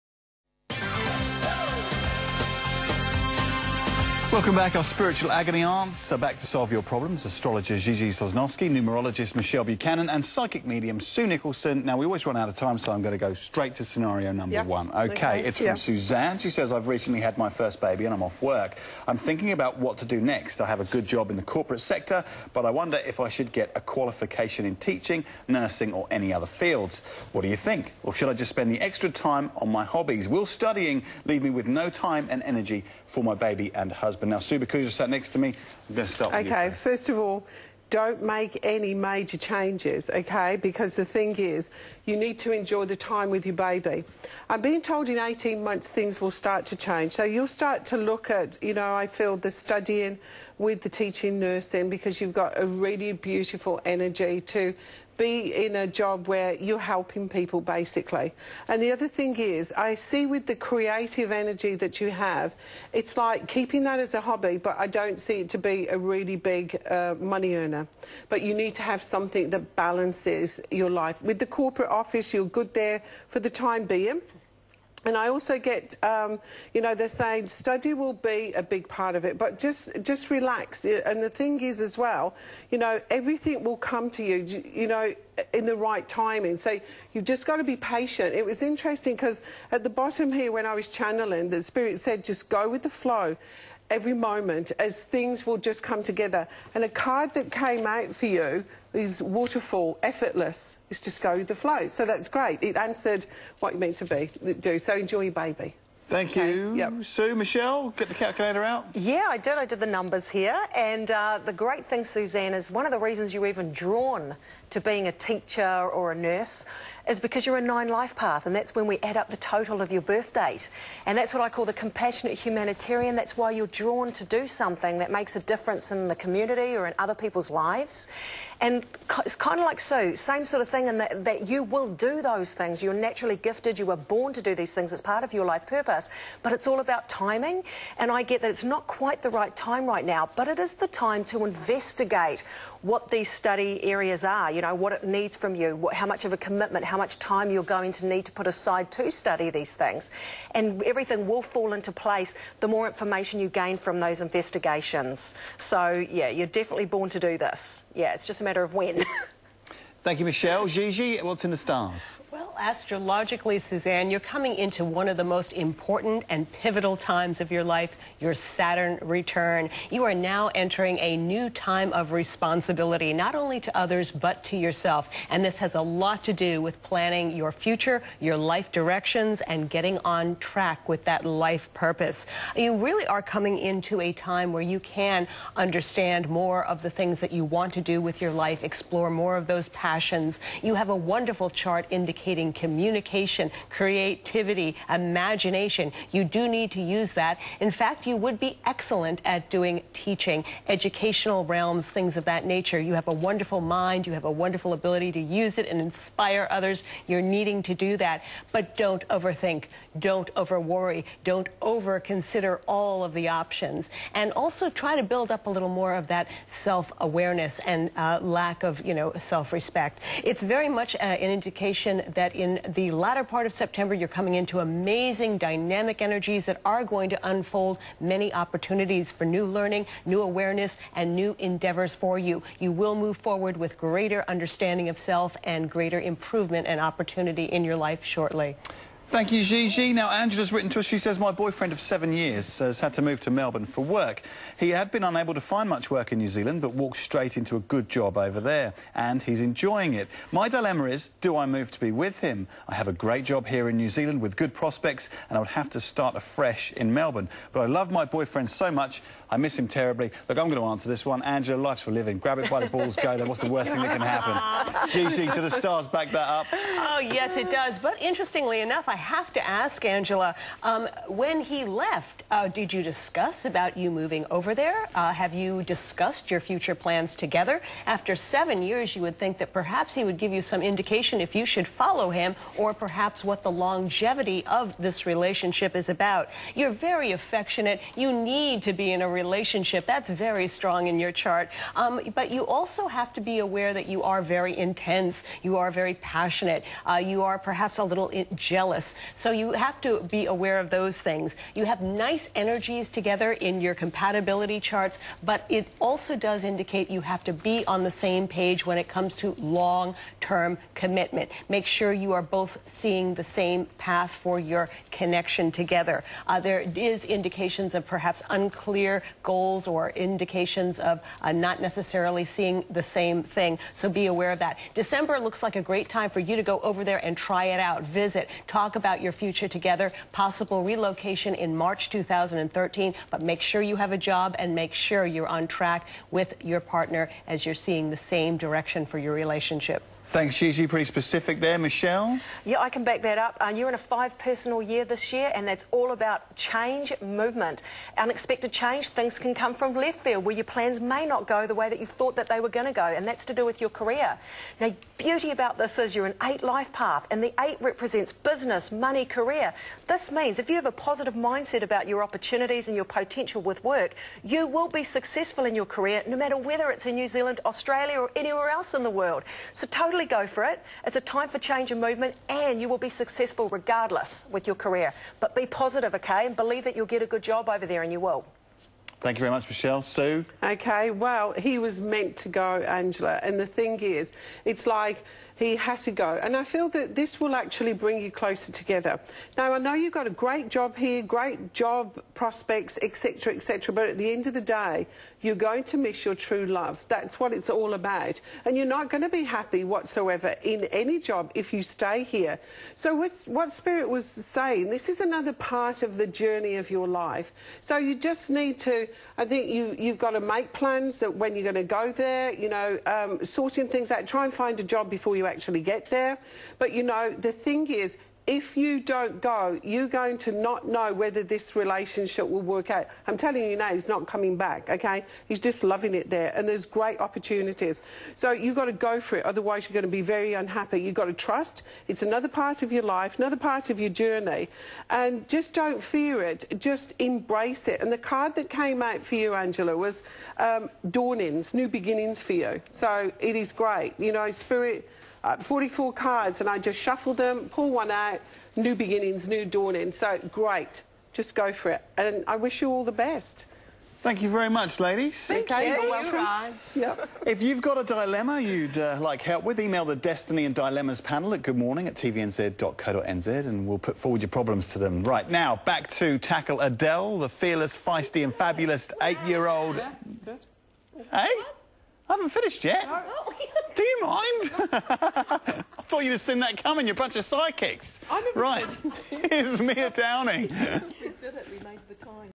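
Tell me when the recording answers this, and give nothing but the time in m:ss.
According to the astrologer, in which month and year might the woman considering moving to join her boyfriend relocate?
5:31.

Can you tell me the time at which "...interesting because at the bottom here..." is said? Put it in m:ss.
1:28.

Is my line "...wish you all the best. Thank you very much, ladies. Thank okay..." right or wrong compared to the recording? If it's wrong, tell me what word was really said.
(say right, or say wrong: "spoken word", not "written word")
right.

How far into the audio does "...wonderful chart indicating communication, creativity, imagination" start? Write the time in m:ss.
3:10.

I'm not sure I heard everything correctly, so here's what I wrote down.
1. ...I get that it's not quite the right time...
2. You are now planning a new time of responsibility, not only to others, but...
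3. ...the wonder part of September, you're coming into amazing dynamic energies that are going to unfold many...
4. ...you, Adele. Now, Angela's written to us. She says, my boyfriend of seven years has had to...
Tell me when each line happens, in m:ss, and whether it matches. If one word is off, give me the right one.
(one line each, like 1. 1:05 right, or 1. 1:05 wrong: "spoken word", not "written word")
1. 2:18 right
2. 2:49 wrong: "entering", not "planning"
3. 3:42 wrong: "latter", not "wonder"
4. 3:59 wrong: "Gigi", not "Adele".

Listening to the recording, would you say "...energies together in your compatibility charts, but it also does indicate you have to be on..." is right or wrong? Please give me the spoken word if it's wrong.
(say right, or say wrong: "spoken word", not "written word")
right.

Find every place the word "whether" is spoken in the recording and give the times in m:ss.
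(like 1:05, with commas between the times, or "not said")
6:06, 7:00.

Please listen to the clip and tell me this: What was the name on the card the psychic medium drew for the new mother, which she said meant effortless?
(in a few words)
Waterfall.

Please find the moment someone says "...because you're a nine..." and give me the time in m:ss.
1:57.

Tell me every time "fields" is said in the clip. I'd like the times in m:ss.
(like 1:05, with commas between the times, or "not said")
0:26, 5:50.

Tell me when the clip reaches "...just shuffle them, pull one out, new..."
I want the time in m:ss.
7:26.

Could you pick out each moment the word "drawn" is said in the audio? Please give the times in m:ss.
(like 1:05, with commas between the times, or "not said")
1:53, 2:03.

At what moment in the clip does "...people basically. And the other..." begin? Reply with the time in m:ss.
0:57.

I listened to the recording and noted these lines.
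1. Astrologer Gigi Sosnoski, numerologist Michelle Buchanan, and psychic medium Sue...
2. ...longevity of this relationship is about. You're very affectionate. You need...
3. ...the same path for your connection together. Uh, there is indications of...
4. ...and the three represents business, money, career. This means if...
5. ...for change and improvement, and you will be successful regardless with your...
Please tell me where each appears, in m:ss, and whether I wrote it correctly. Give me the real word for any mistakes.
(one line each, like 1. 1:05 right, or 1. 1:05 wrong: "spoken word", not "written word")
1. 0:07 right
2. 4:43 right
3. 5:13 right
4. 5:57 wrong: "eight", not "three"
5. 6:11 wrong: "movement", not "improvement".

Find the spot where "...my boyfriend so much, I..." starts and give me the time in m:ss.
4:17.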